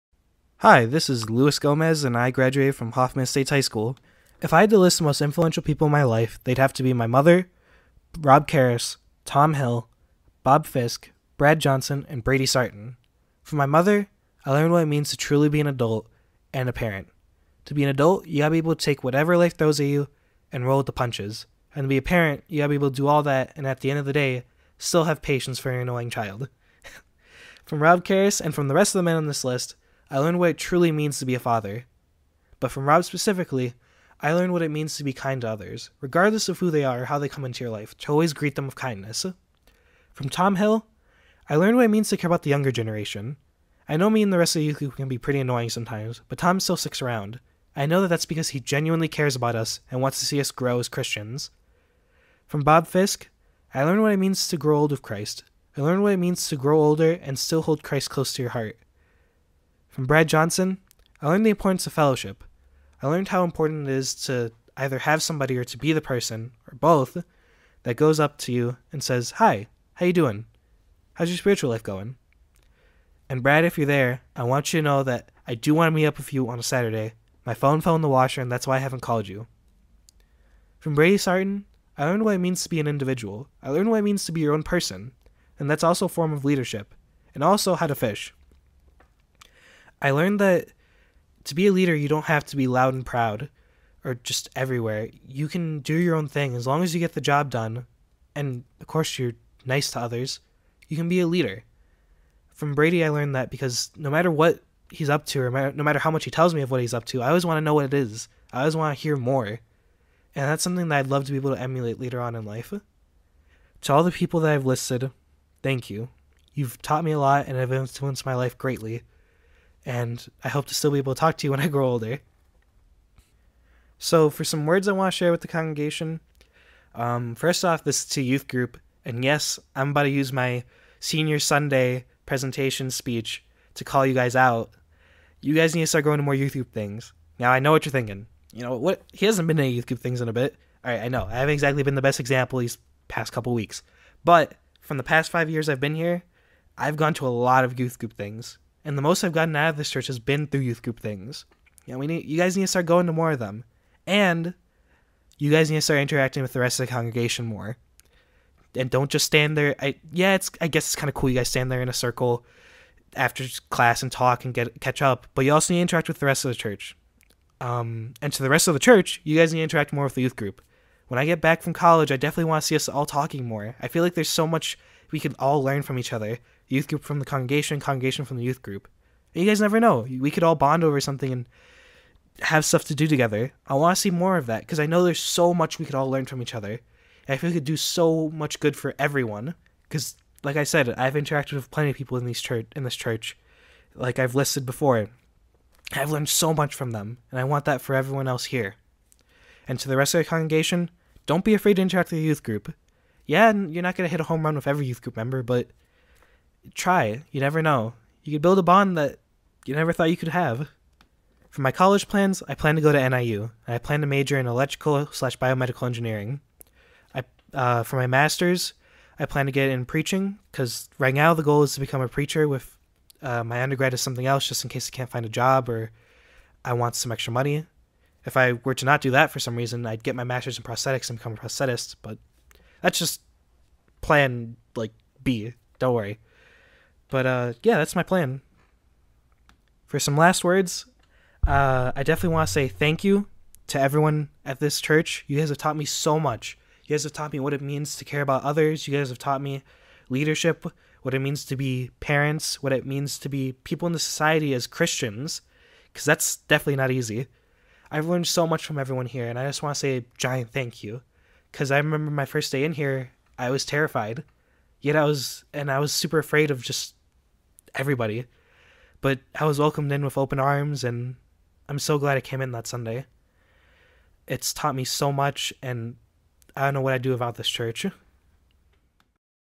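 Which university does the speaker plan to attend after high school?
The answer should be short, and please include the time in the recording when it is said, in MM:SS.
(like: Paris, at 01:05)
NIU, at 03:33.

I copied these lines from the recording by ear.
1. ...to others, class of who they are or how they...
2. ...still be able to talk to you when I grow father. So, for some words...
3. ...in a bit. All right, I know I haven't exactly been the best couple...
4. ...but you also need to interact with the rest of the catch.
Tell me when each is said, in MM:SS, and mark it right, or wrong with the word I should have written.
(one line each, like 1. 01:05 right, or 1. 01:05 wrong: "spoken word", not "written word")
1. 00:35 wrong: "regardless", not "class"
2. 02:00 wrong: "older", not "father"
3. 02:20 wrong: "example", not "couple"
4. 02:45 wrong: "church", not "catch".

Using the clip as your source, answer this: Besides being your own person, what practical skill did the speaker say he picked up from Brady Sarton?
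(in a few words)
How to fish.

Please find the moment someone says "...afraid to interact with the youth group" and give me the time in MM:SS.
03:21.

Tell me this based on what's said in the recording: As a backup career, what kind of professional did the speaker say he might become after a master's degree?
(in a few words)
Prosthetist.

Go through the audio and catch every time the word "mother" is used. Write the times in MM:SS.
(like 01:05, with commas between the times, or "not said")
00:07, 00:13.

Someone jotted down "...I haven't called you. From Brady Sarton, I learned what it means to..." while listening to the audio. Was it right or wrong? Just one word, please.
right.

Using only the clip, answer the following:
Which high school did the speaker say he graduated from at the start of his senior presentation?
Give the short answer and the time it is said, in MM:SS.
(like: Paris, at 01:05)
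Hoffman Estates High School, at 00:02.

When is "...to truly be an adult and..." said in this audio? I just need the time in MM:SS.
00:15.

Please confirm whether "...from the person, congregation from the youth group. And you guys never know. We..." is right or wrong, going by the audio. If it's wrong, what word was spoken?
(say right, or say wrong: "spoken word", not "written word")
wrong: "congregation", not "person".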